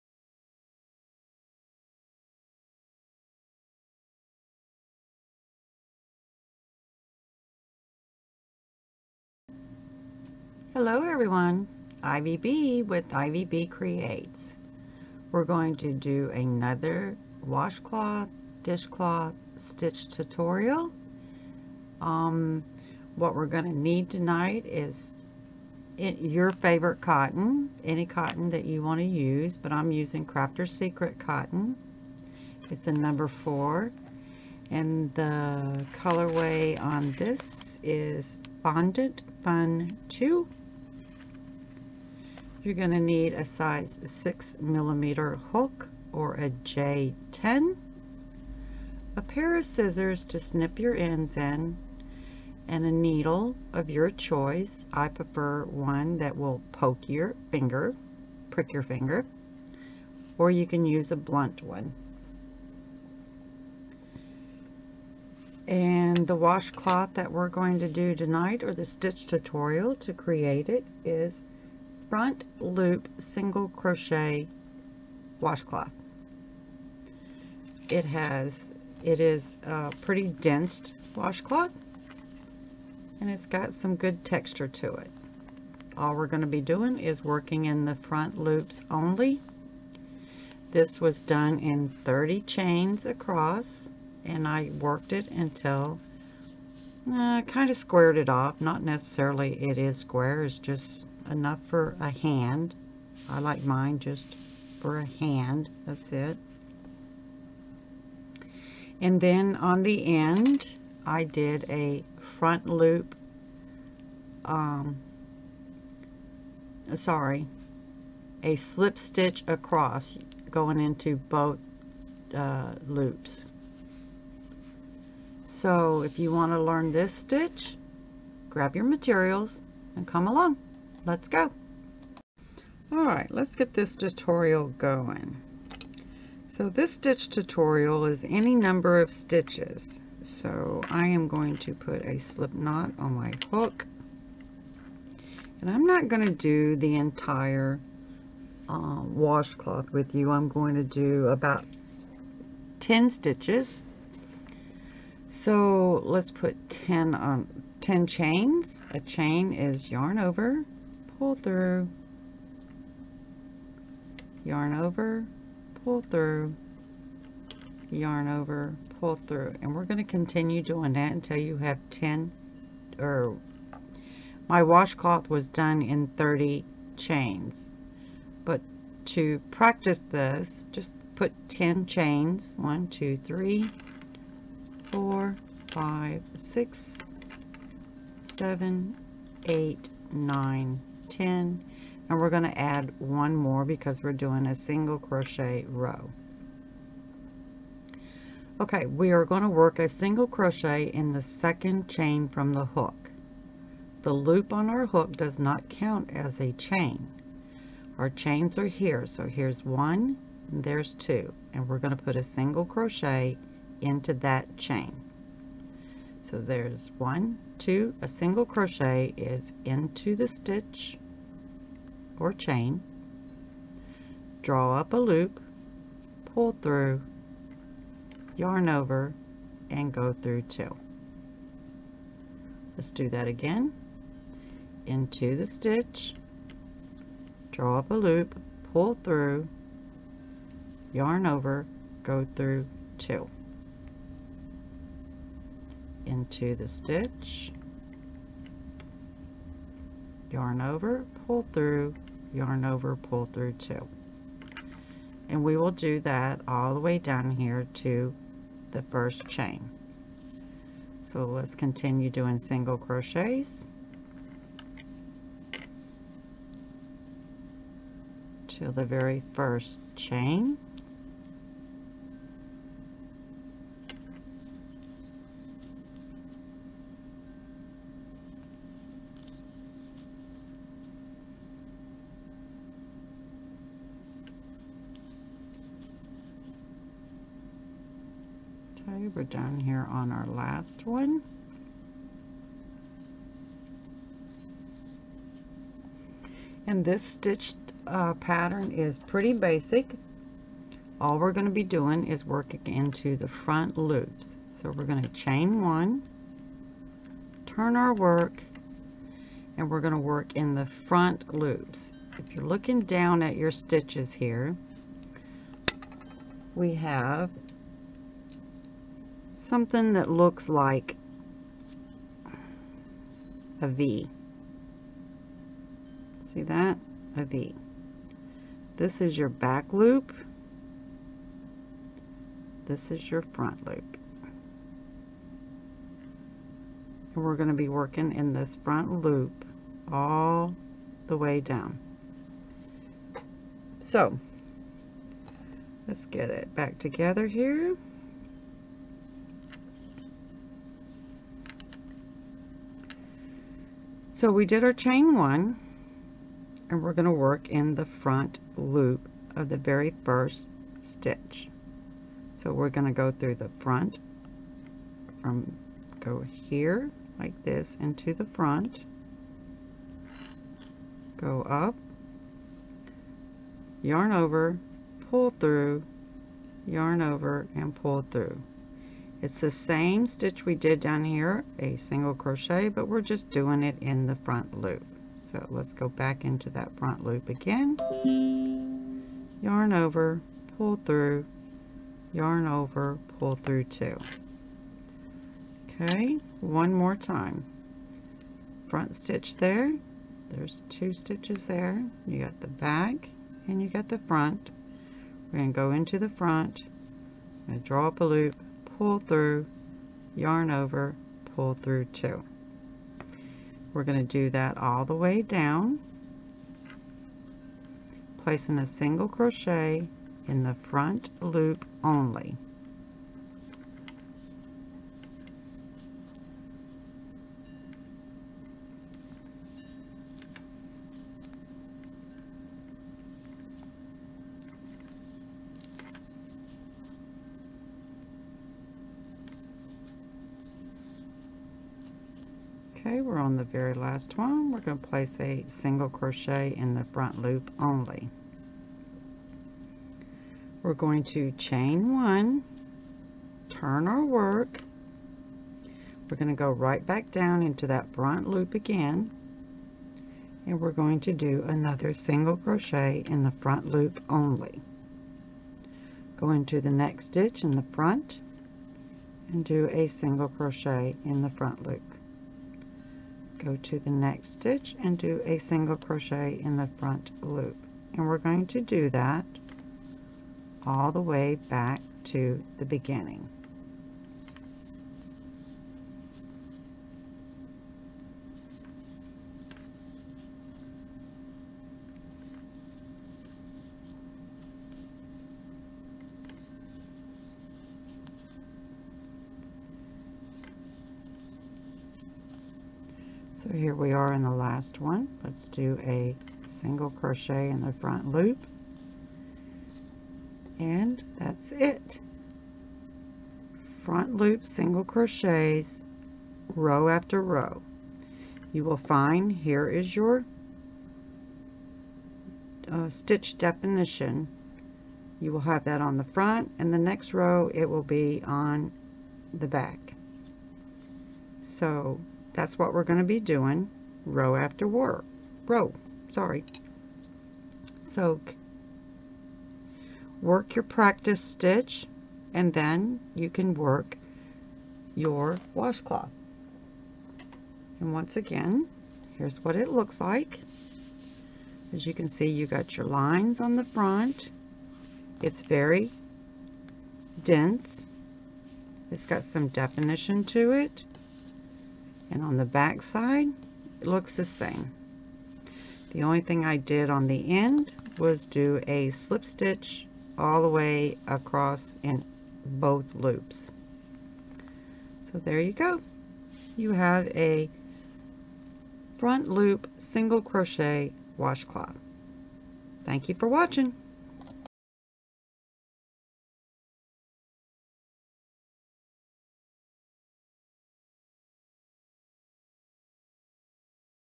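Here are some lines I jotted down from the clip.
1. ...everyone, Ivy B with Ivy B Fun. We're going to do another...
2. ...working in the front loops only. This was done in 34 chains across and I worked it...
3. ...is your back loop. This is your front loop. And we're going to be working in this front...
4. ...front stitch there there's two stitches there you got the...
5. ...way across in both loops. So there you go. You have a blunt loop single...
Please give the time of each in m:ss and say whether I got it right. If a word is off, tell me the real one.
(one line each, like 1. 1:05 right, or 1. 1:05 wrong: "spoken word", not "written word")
1. 0:11 wrong: "Creates", not "Fun"
2. 1:27 wrong: "30", not "34"
3. 5:29 right
4. 6:38 right
5. 9:30 wrong: "front", not "blunt".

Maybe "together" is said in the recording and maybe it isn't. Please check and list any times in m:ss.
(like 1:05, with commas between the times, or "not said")
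5:46.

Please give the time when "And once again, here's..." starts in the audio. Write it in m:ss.
9:07.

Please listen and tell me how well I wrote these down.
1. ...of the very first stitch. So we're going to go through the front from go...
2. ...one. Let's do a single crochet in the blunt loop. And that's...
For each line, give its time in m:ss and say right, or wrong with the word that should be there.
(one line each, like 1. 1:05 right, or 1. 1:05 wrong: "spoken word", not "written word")
1. 5:59 right
2. 8:24 wrong: "front", not "blunt".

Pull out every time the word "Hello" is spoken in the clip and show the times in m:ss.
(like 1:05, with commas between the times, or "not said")
0:10.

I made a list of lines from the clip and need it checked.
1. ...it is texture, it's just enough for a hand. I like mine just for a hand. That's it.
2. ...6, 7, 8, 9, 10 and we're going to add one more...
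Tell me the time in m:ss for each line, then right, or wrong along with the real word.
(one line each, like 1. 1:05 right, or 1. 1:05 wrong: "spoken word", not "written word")
1. 1:39 wrong: "square", not "texture"
2. 3:06 right.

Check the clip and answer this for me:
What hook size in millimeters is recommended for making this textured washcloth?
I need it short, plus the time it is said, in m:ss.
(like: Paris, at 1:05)
6 millimeters, at 0:44.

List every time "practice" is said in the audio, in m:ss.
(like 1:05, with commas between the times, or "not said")
2:59, 9:00.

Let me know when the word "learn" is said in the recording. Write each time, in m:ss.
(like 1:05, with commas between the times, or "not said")
2:06.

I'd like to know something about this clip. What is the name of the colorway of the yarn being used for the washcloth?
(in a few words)
Fondant Fun 2.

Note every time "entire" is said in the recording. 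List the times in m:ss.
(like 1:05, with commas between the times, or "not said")
2:26.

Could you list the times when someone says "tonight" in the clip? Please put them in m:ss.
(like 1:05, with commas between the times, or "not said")
0:24, 1:08.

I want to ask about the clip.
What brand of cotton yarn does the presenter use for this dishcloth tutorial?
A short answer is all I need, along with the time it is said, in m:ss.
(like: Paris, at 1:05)
Crafter's Secret, at 0:30.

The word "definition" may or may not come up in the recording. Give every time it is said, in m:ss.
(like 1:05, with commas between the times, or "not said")
8:43, 9:19.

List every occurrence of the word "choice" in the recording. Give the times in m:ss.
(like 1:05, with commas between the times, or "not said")
0:54.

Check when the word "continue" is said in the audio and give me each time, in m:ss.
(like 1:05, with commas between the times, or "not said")
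2:50, 4:21.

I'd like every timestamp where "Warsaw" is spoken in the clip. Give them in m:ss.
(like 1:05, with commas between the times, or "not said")
not said.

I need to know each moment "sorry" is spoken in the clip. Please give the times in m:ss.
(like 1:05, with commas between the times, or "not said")
1:56, 8:56.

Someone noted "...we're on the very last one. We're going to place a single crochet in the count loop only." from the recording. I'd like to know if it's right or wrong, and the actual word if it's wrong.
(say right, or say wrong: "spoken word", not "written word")
wrong: "front", not "count".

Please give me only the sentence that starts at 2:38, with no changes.
A chain is yarn over, pull through, yarn over, pull through, yarn over, pull through.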